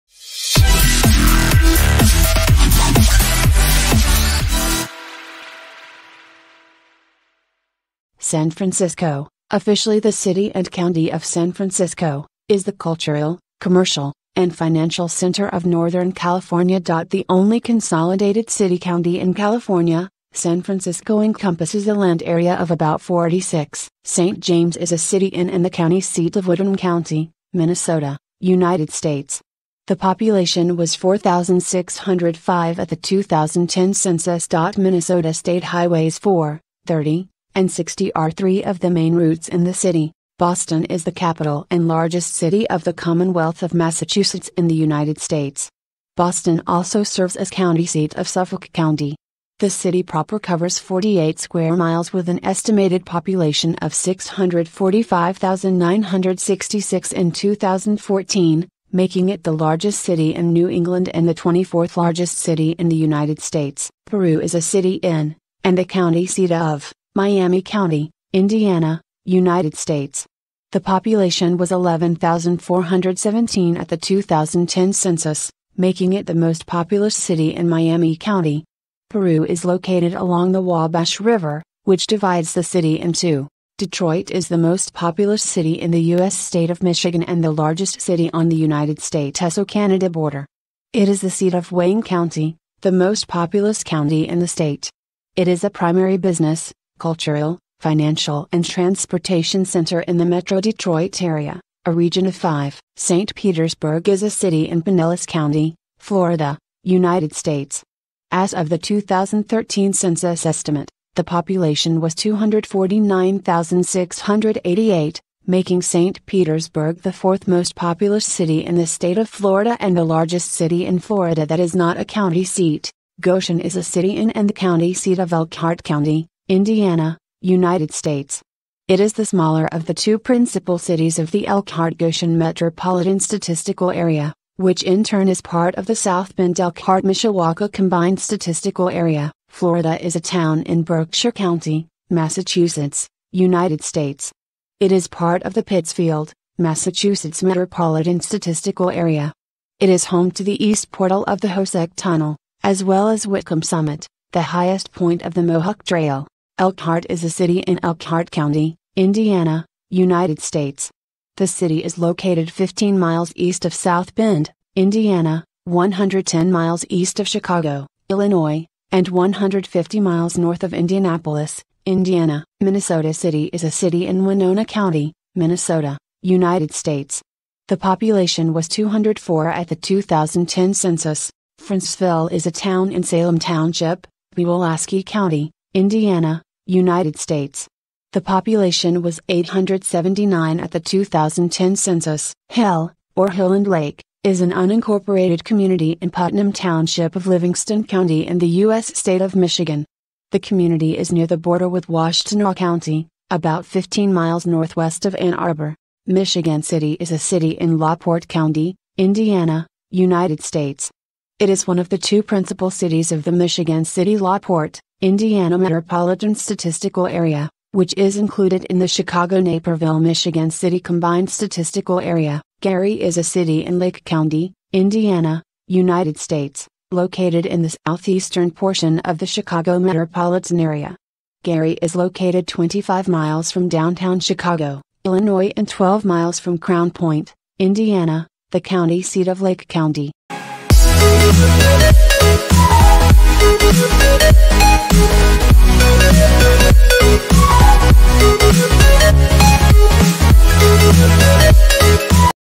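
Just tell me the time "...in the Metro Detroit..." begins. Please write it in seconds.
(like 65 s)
100 s.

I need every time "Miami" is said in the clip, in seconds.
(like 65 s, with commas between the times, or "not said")
67 s, 77 s.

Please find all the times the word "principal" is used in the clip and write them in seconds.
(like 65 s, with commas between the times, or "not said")
130 s, 212 s.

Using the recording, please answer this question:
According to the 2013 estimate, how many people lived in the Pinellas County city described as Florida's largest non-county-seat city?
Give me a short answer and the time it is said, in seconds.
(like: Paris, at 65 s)
249,688, at 112 s.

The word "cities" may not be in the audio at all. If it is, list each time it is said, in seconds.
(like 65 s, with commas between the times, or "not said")
130 s, 212 s.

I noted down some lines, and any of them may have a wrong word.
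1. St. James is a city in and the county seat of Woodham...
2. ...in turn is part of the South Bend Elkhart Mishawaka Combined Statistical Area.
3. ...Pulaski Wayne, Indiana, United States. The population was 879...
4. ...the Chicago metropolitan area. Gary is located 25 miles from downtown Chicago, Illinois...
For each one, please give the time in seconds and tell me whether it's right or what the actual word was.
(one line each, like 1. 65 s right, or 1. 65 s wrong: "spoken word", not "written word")
1. 24 s right
2. 134 s right
3. 184 s wrong: "County", not "Wayne"
4. 229 s right.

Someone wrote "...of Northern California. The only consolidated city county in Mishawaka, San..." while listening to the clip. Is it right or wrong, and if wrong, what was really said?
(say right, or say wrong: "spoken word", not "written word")
wrong: "California", not "Mishawaka".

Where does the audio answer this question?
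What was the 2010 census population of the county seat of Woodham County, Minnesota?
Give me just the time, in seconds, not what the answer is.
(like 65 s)
30 s.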